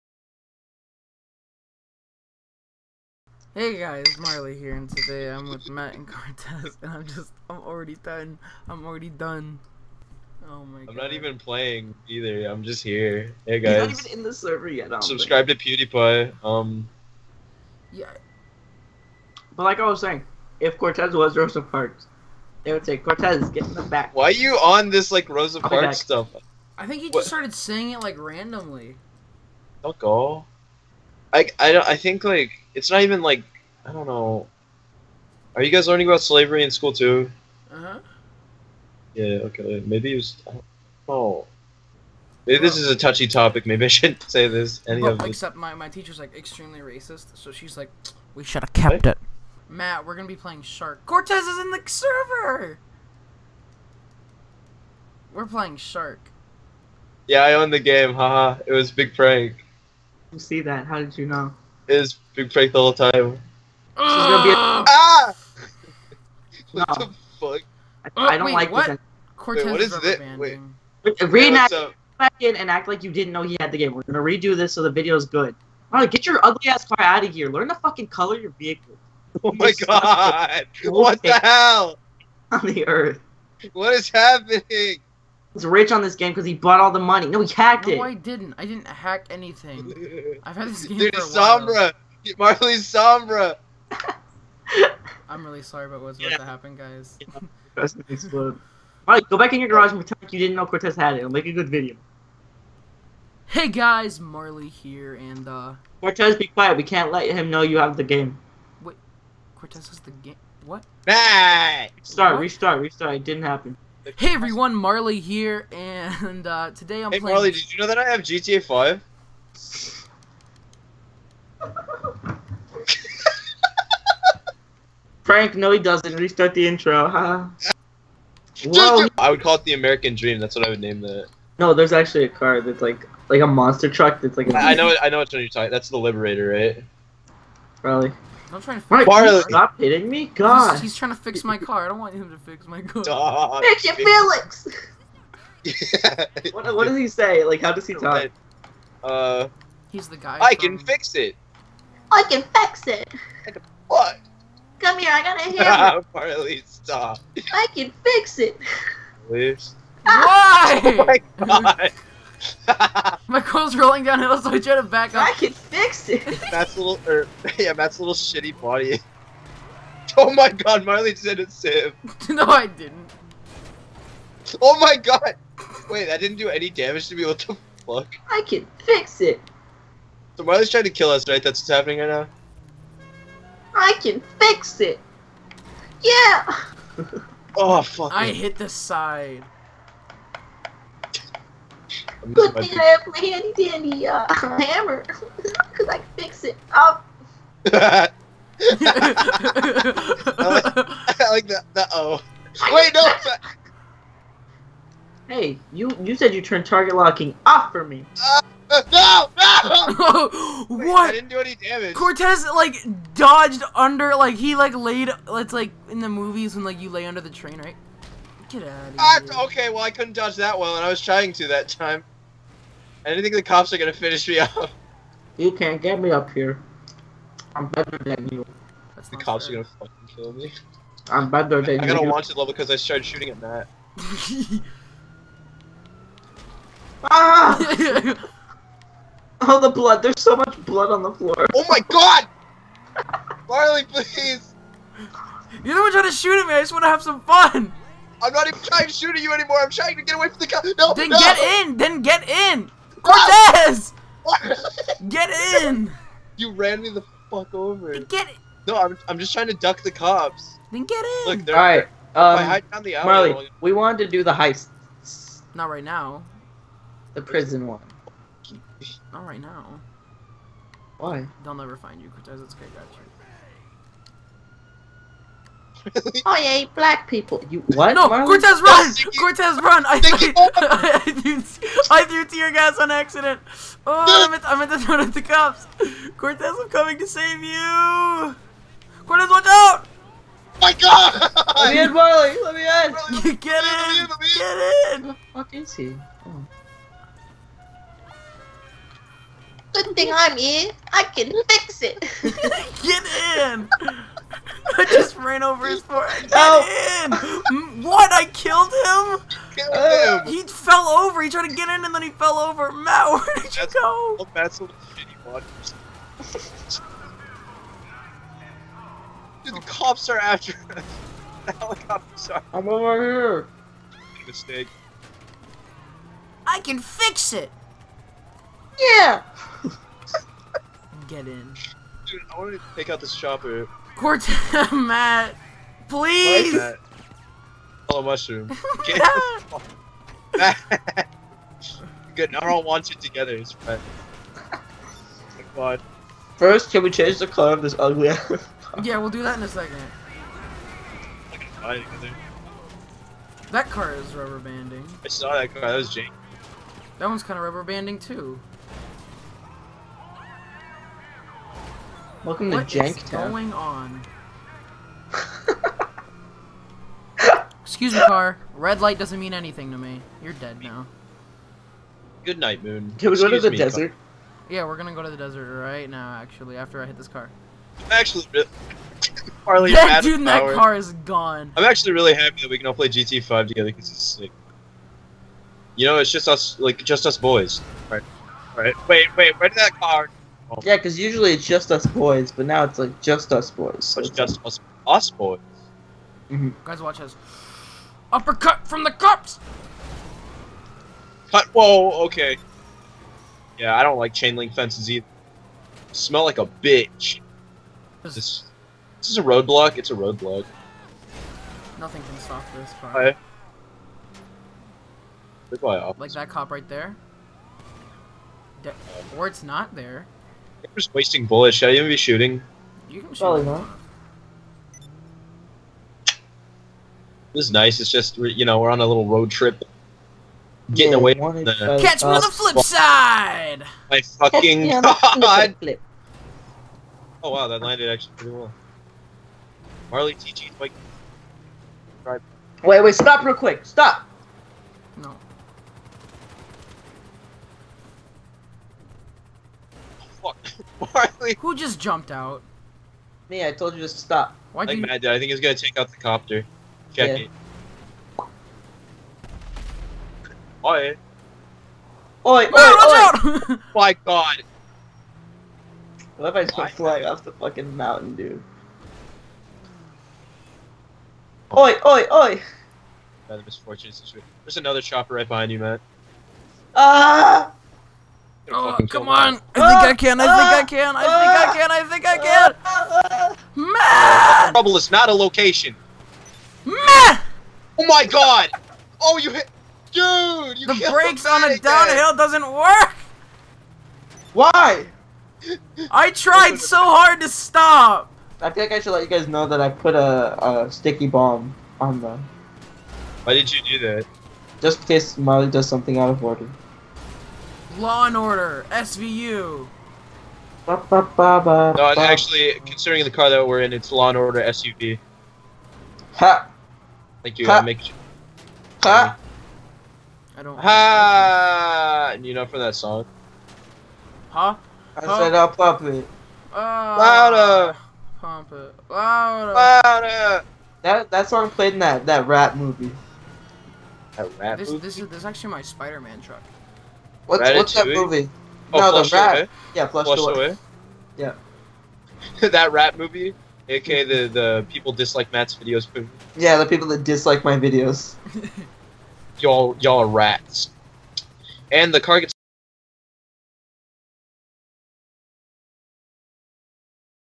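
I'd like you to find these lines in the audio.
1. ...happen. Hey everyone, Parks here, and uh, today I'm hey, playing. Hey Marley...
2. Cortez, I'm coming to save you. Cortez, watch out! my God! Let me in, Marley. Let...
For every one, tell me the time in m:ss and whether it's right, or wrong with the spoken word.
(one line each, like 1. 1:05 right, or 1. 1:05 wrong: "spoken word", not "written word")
1. 1:53 wrong: "Marley", not "Parks"
2. 4:46 right.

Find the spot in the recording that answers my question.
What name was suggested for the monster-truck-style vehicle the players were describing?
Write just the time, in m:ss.
2:15.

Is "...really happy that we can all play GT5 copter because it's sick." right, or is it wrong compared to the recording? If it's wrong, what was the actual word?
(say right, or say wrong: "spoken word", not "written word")
wrong: "together", not "copter".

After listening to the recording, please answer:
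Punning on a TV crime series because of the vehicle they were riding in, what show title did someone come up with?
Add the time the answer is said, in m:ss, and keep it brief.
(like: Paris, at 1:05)
Law and Order SUV, at 8:33.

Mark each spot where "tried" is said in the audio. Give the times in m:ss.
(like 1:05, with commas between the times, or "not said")
5:11, 8:16.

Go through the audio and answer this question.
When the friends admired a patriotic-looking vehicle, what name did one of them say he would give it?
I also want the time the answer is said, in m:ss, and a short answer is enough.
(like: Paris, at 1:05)
American Dream, at 2:09.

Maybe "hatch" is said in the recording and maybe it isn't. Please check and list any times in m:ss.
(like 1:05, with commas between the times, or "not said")
not said.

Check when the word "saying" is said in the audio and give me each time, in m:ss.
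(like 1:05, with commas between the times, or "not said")
0:19, 0:27.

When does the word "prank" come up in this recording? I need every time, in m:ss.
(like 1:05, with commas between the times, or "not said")
0:59.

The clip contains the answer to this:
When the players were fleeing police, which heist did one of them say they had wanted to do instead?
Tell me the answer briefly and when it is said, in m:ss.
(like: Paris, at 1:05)
The prison one, at 4:27.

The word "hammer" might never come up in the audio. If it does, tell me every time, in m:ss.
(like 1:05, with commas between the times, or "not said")
2:35, 3:14.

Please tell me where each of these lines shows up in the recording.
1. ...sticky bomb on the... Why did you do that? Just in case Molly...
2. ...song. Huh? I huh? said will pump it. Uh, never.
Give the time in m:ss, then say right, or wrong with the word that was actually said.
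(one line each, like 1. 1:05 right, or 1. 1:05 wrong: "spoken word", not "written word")
1. 8:20 right
2. 8:42 wrong: "louder", not "never".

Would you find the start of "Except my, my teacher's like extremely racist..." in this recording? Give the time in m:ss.
0:45.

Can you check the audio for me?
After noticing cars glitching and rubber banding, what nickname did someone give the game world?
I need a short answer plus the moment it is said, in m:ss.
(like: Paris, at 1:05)
Jank Town, at 6:02.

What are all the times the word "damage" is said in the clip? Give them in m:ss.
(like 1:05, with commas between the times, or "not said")
2:56, 3:31.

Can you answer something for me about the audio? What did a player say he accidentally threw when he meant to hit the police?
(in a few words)
Tear gas.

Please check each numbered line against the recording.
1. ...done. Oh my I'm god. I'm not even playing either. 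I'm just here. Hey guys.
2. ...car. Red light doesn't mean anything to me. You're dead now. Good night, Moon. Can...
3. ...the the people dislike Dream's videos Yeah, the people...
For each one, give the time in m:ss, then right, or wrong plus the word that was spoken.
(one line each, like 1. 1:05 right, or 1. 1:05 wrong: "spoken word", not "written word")
1. 0:09 right
2. 6:08 right
3. 9:04 wrong: "Matt", not "Dream".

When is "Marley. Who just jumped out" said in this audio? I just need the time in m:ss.
7:30.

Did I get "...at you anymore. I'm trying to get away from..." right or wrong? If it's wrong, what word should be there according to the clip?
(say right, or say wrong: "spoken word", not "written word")
right.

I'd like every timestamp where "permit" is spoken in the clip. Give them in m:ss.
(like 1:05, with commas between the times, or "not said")
not said.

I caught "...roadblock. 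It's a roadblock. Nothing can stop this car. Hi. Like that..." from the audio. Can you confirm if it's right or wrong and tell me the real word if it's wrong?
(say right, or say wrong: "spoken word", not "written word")
right.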